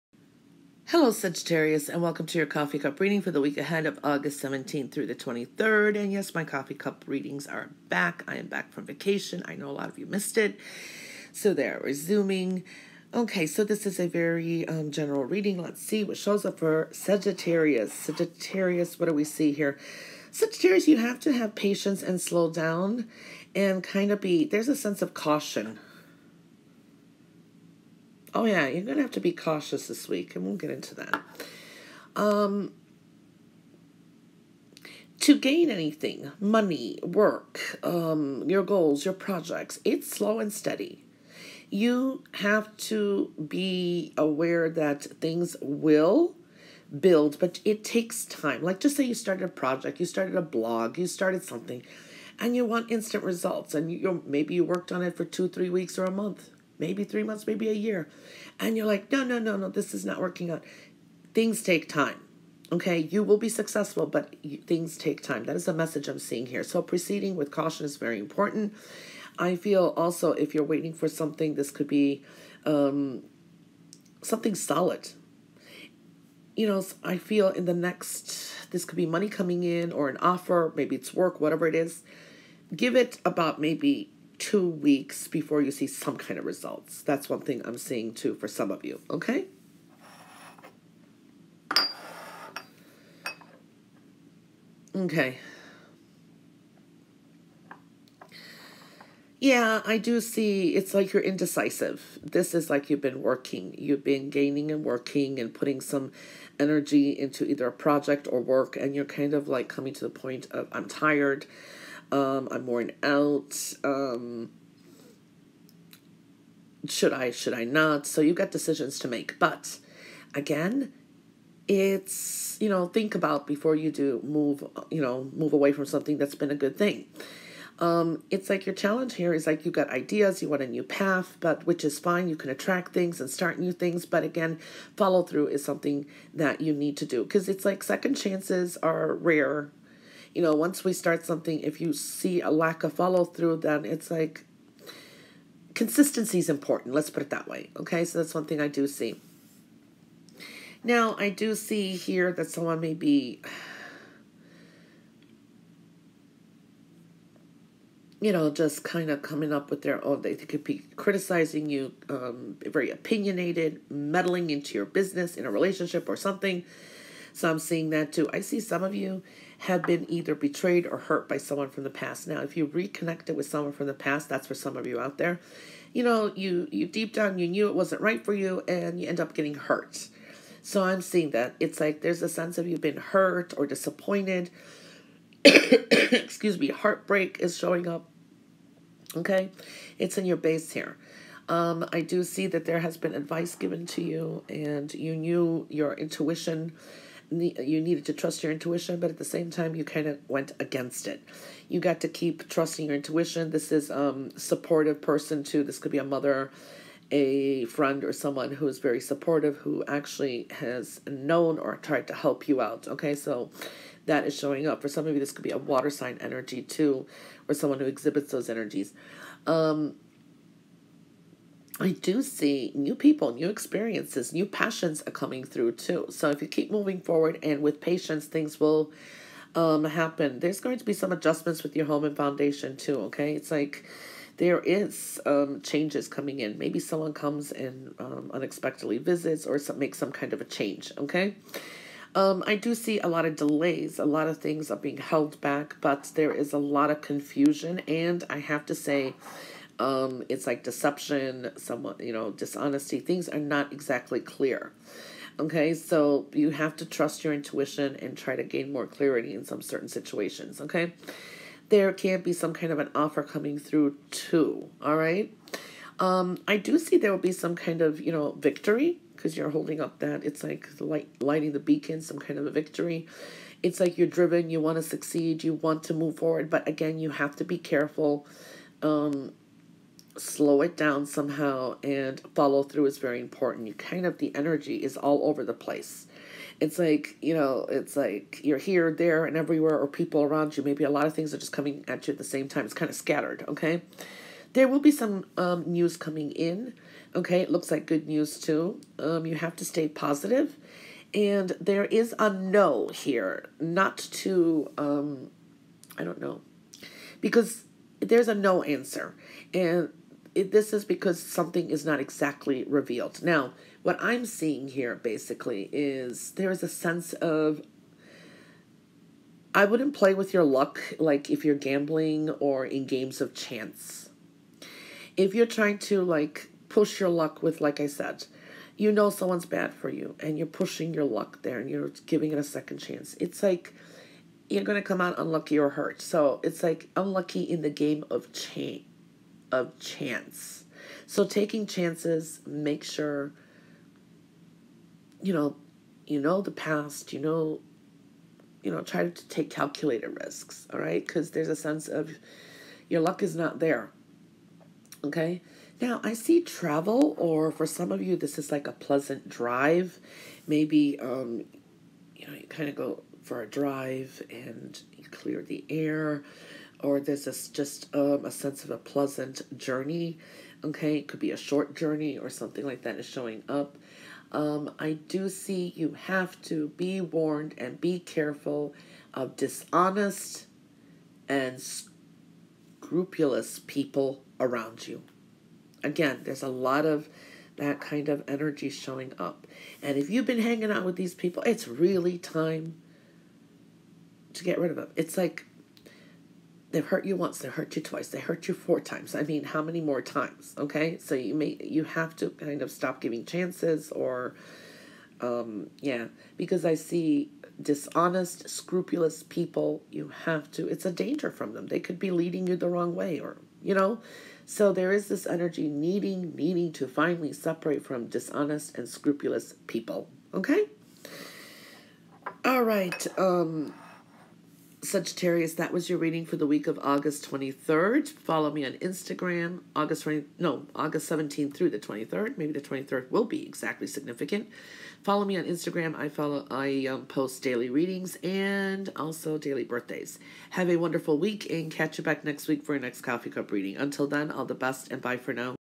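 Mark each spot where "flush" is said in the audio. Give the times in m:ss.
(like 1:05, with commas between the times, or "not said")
not said.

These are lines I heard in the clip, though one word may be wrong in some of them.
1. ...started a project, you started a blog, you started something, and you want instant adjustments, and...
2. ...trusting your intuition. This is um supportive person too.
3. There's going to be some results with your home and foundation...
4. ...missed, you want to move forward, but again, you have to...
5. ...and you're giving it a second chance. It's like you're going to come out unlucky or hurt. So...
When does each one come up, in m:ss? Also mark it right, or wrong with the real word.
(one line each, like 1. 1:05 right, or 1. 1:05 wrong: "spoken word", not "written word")
1. 0:49 wrong: "results", not "adjustments"
2. 3:22 right
3. 3:50 wrong: "adjustments", not "results"
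4. 4:34 wrong: "succeed", not "missed"
5. 5:31 right.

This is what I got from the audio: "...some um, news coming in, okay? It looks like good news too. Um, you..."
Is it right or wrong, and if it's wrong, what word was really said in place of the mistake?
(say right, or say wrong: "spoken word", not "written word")
right.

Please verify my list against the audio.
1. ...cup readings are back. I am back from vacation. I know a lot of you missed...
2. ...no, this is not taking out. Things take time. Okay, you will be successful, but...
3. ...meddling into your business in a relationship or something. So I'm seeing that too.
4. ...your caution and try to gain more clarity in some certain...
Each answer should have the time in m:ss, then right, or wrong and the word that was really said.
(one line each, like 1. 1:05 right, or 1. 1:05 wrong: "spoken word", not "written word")
1. 0:06 right
2. 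0:59 wrong: "working", not "taking"
3. 2:43 right
4. 4:17 wrong: "intuition", not "caution".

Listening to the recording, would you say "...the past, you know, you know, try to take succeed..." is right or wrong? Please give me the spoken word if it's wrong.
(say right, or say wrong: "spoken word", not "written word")
wrong: "calculated", not "succeed".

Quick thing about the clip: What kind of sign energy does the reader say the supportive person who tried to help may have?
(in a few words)
water sign.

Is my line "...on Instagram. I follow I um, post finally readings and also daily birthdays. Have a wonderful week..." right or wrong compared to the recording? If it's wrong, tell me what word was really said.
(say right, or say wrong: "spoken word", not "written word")
wrong: "daily", not "finally".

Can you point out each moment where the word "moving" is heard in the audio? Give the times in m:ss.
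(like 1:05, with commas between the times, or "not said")
3:46.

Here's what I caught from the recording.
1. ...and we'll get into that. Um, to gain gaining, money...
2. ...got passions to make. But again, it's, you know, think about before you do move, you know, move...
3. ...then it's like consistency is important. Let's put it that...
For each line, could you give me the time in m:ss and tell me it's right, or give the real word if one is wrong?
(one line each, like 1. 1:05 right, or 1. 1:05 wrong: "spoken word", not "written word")
1. 0:30 wrong: "anything", not "gaining"
2. 1:58 wrong: "decisions", not "passions"
3. 2:23 right.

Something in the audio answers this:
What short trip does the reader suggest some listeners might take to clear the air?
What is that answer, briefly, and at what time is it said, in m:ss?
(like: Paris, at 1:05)
a pleasant drive, at 5:58.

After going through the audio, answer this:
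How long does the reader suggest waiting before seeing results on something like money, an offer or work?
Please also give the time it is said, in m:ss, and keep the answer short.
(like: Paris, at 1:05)
2 weeks, at 1:24.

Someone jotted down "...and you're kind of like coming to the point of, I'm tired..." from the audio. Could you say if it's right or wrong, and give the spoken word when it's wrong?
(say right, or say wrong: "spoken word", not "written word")
right.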